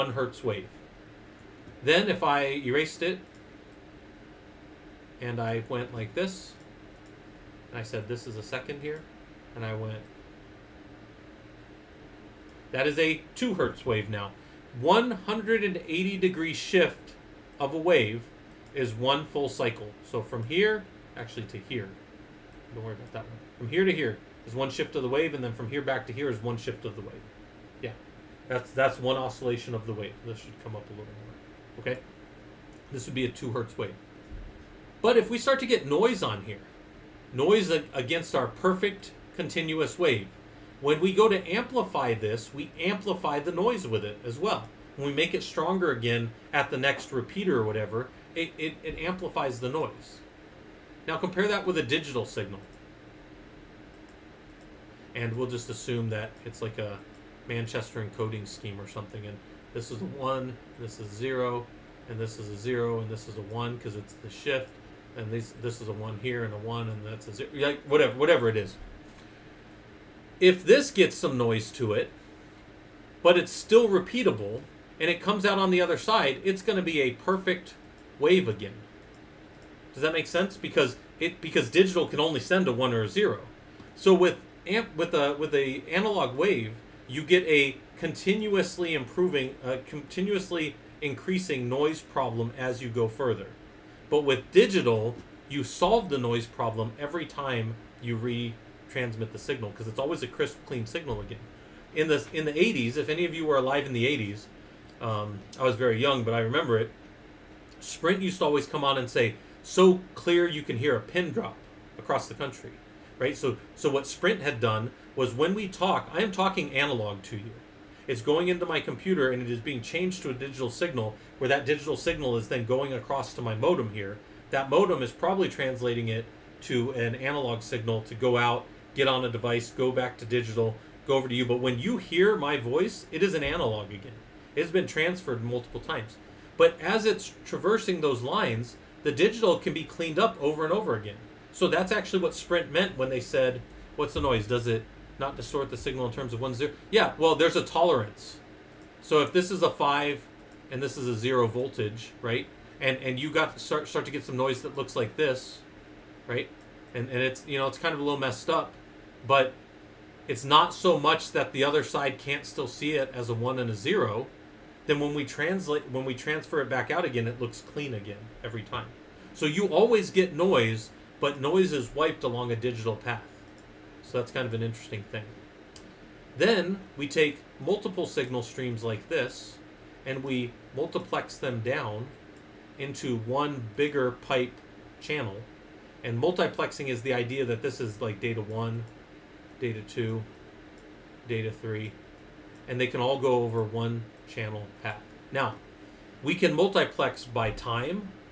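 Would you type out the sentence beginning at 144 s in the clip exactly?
Does it not distort the signal in terms of one zero?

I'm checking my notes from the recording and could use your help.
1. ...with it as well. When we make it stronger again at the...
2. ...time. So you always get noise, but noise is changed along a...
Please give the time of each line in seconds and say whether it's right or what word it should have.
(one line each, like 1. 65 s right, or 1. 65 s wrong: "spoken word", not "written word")
1. 43 s right
2. 168 s wrong: "wiped", not "changed".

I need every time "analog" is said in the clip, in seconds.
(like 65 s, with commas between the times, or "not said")
85 s, 116 s, 127 s, 133 s.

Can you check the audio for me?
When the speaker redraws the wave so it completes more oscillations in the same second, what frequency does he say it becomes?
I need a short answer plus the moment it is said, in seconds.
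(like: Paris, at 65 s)
2 hertz, at 13 s.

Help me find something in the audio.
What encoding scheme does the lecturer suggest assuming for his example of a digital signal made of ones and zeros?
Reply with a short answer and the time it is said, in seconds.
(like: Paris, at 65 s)
Manchester encoding, at 57 s.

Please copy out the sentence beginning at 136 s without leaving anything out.
But as it's traversing those lines, the digital can be cleaned up over and over again.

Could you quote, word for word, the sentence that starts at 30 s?
This should come up a little more.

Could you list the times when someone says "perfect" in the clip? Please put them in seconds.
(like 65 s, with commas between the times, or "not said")
38 s, 77 s.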